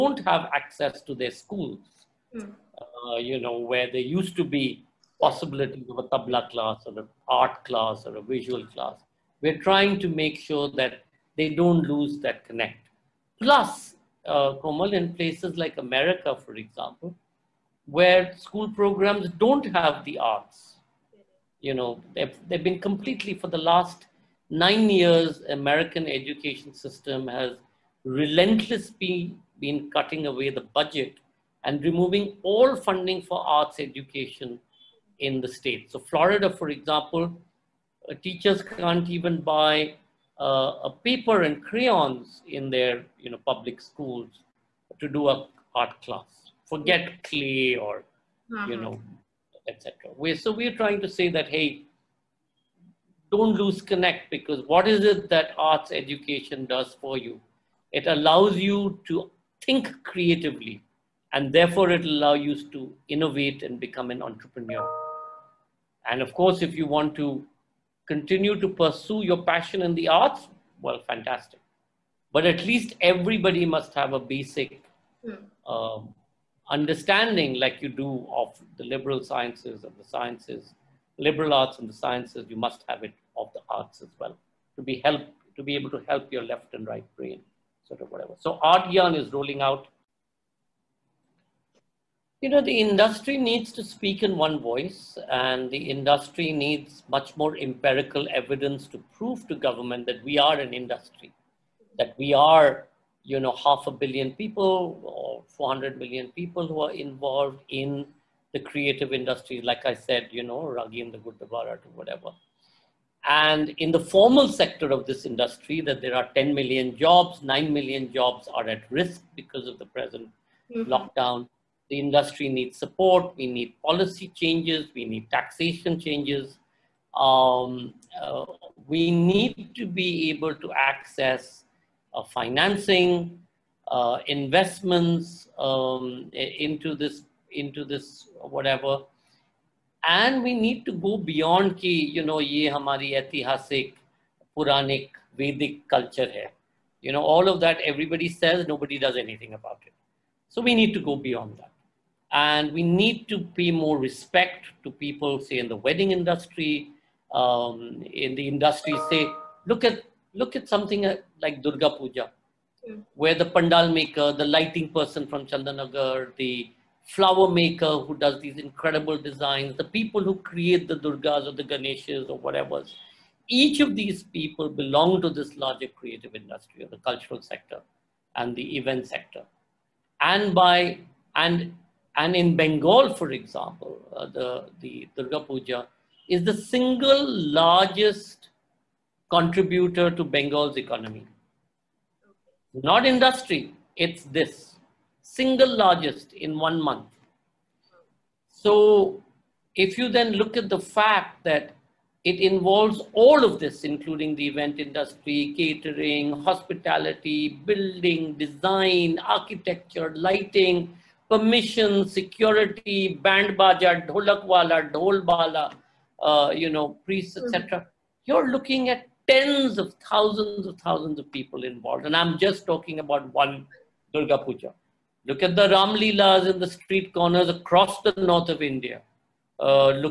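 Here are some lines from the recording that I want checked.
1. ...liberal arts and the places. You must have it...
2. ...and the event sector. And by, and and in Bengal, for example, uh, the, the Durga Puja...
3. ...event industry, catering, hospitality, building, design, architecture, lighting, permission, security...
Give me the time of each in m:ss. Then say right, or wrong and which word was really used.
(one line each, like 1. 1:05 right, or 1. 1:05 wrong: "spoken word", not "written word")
1. 1:21 wrong: "sciences", not "places"
2. 2:58 right
3. 3:24 right.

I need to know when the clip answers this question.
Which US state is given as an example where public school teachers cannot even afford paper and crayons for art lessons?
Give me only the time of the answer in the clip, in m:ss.
0:35.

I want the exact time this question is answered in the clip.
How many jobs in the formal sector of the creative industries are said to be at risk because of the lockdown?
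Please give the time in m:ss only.
1:57.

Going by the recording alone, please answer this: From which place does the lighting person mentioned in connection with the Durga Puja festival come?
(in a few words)
Chandanagar.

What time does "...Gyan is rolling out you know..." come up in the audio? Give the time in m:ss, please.
1:28.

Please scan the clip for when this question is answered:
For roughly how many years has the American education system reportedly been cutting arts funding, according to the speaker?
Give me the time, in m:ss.
0:24.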